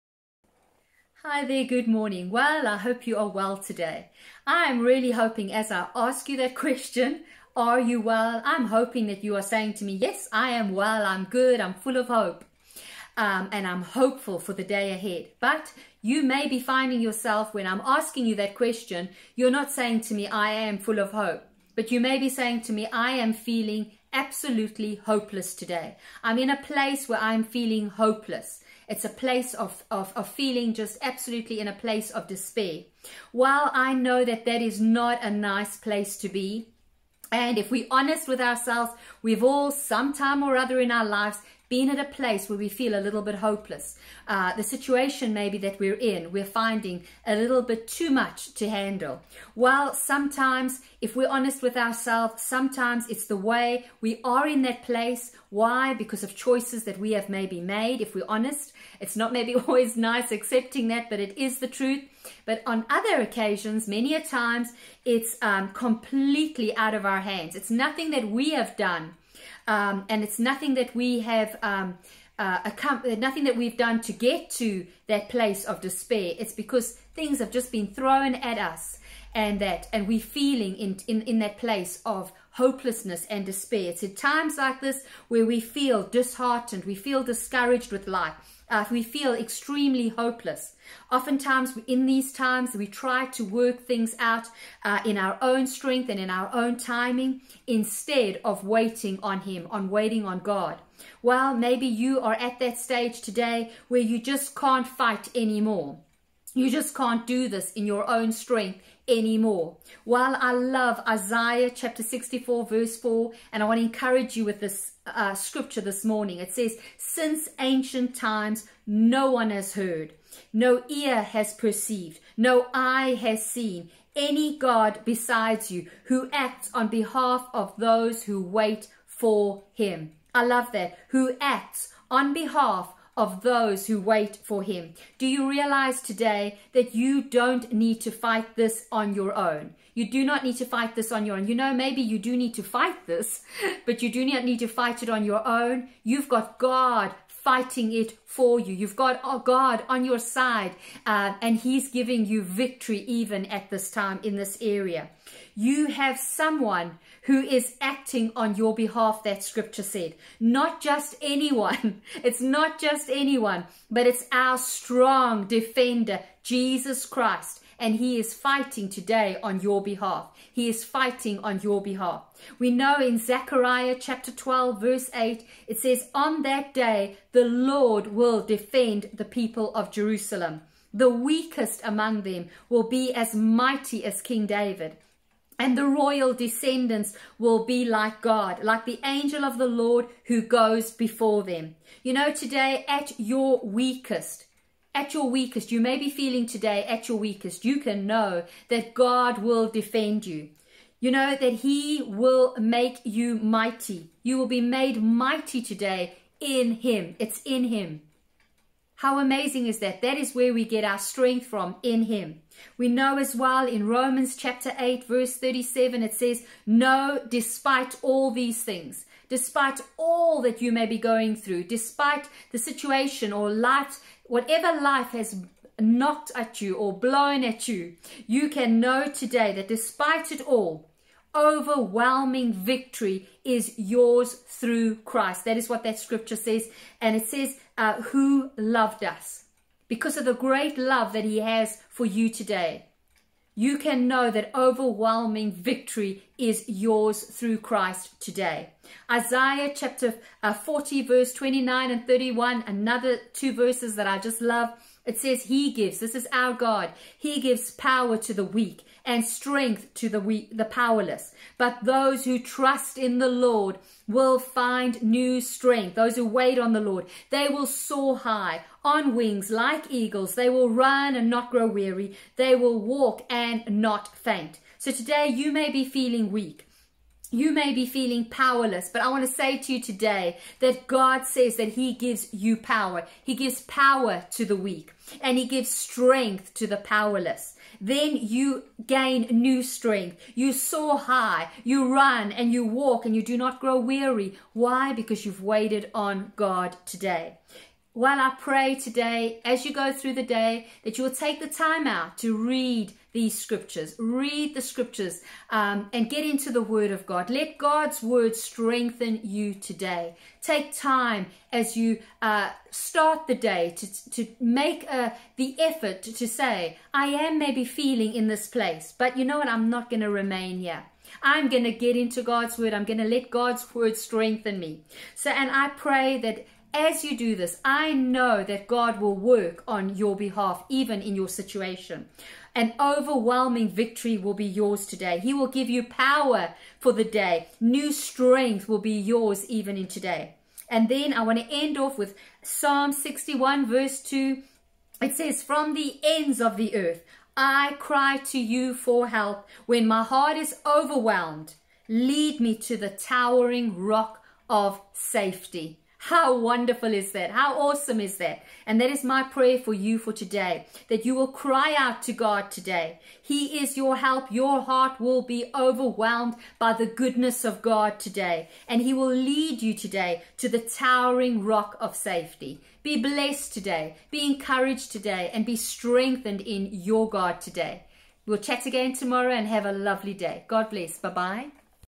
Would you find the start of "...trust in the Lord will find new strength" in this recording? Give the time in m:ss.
4:22.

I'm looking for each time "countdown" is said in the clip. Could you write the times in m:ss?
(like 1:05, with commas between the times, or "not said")
not said.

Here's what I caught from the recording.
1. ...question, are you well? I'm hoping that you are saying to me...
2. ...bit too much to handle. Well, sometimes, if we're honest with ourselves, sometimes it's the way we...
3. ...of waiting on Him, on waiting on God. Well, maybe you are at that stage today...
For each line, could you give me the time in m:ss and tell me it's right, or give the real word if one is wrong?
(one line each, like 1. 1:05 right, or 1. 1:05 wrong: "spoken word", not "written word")
1. 0:06 right
2. 0:47 right
3. 1:38 right.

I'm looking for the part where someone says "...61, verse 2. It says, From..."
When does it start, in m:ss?
5:42.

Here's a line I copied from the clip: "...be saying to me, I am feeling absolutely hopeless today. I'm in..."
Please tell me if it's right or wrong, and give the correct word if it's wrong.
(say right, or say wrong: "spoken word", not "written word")
right.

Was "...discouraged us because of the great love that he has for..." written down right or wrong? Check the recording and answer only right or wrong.
wrong.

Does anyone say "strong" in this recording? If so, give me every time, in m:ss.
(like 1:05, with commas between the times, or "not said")
2:44.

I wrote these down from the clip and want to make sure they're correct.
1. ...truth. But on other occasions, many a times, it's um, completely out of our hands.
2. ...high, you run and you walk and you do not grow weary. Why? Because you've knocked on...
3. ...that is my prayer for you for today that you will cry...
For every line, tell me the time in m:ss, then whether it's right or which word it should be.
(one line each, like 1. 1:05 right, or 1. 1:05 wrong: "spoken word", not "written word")
1. 1:01 right
2. 4:50 wrong: "waited", not "knocked"
3. 5:58 right.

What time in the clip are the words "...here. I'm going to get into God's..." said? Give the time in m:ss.
5:20.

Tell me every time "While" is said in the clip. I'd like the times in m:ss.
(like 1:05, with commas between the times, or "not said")
0:33, 1:50.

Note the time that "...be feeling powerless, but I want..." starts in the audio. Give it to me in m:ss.
4:37.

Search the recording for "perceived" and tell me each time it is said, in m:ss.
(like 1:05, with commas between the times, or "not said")
2:01.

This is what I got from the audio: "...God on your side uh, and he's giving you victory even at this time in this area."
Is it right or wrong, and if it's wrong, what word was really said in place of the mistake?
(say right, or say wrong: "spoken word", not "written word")
right.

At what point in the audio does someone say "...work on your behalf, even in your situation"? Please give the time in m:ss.
5:29.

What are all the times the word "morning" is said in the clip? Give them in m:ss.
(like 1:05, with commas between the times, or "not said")
0:01, 1:56.